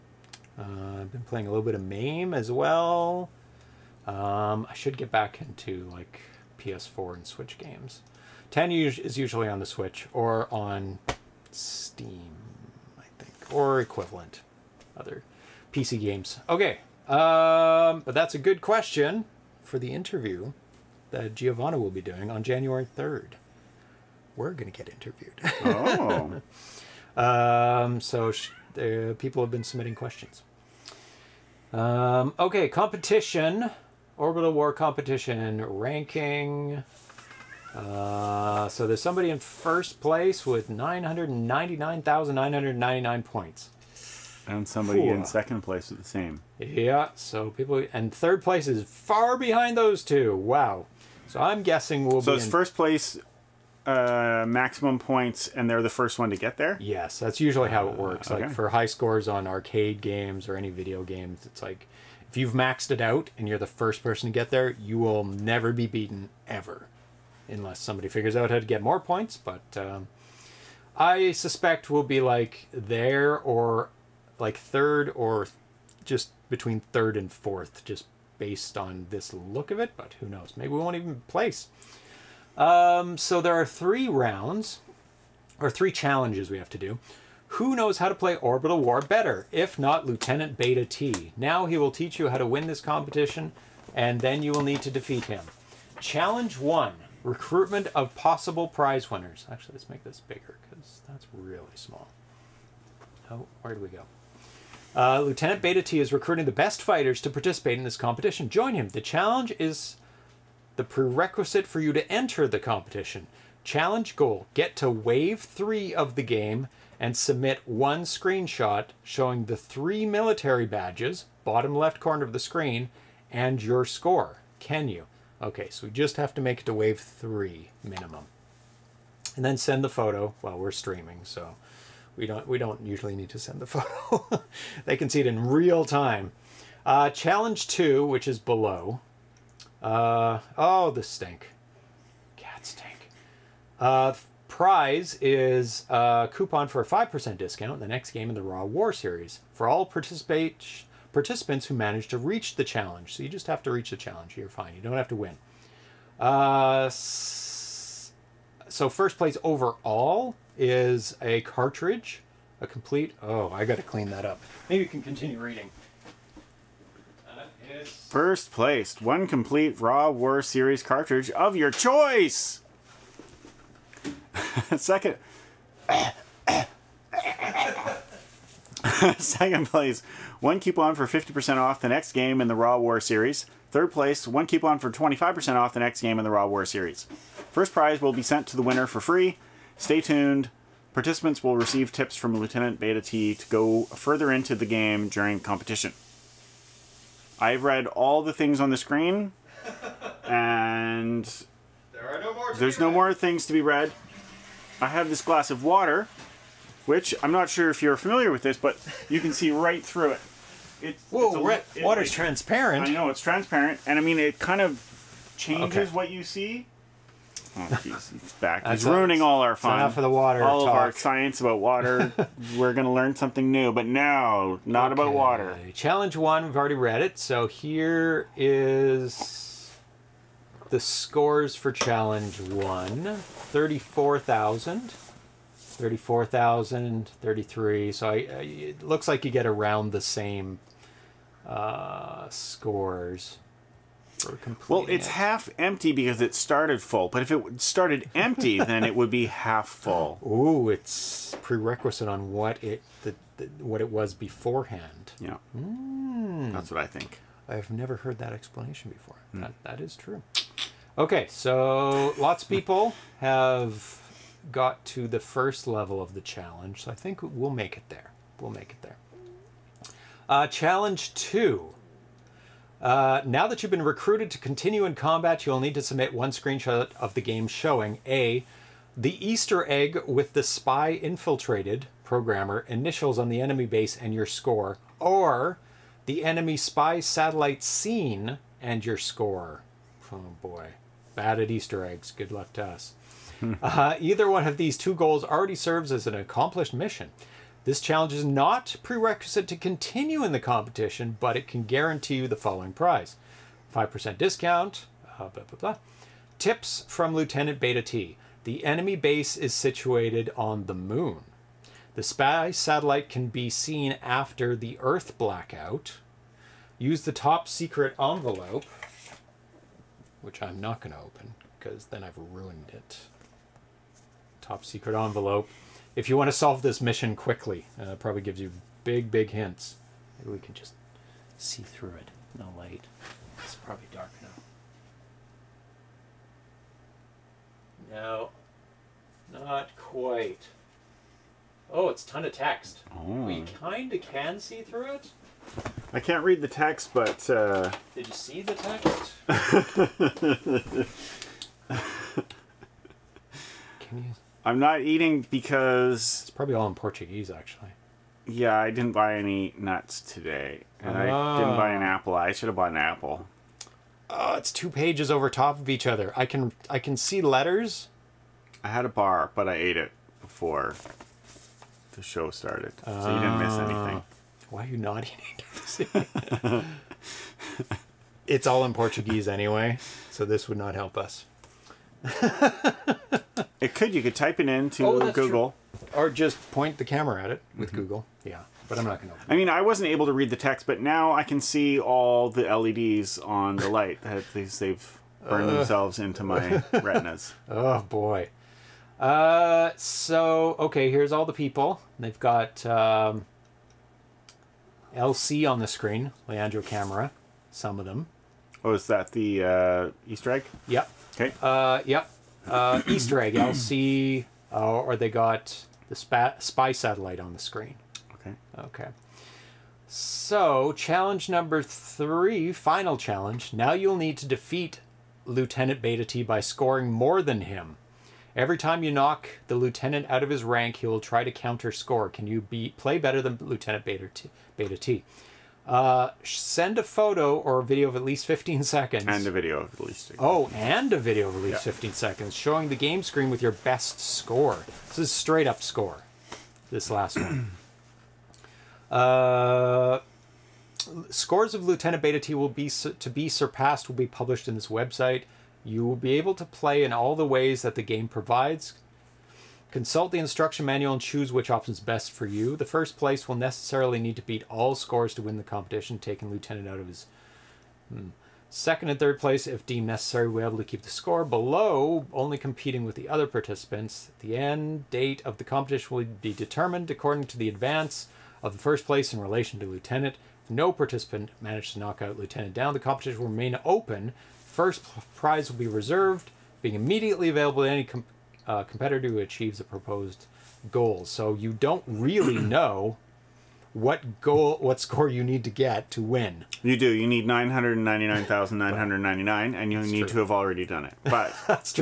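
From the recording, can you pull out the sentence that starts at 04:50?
Oh boy, bad at Easter eggs.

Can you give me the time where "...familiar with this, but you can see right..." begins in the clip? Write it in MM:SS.
03:27.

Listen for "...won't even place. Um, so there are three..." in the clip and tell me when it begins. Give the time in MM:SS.
01:20.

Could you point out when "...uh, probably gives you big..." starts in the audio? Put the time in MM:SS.
05:27.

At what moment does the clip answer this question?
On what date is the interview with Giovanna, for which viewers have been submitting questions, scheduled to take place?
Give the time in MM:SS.
00:22.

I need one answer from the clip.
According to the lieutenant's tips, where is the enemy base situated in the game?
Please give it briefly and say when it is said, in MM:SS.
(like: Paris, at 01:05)
The moon, at 05:10.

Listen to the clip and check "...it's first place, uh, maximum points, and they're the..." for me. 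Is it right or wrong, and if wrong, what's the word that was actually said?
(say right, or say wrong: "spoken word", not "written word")
right.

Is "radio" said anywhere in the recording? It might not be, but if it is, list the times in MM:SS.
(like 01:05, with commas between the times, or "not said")
not said.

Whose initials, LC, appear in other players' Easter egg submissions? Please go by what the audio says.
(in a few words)
Leandro Camara.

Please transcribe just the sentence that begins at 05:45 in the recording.
I can't read the text, but.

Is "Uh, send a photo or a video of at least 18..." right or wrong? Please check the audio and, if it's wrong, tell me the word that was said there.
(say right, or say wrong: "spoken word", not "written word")
wrong: "15", not "18".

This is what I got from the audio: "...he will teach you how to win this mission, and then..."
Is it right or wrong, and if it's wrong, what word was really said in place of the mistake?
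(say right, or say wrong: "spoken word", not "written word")
wrong: "competition", not "mission".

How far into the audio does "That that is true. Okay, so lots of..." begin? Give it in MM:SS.
04:19.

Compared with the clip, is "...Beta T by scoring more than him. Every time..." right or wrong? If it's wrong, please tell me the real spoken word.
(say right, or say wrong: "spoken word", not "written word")
right.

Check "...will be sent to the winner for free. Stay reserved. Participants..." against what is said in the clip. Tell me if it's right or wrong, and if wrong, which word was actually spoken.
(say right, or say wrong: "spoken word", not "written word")
wrong: "tuned", not "reserved".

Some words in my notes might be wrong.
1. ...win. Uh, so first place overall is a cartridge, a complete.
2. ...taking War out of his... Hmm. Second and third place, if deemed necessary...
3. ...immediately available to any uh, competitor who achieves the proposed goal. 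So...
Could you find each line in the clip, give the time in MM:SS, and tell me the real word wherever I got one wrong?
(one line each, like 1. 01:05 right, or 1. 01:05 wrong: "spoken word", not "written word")
1. 02:35 right
2. 07:45 wrong: "Lieutenant", not "War"
3. 08:06 right.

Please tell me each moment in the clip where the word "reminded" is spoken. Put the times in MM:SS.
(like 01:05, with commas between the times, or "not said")
not said.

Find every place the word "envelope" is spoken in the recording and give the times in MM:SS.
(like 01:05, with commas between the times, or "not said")
05:17, 05:24.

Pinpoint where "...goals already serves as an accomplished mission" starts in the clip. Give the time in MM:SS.
04:54.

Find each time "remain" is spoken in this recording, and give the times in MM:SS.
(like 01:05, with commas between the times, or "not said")
08:03.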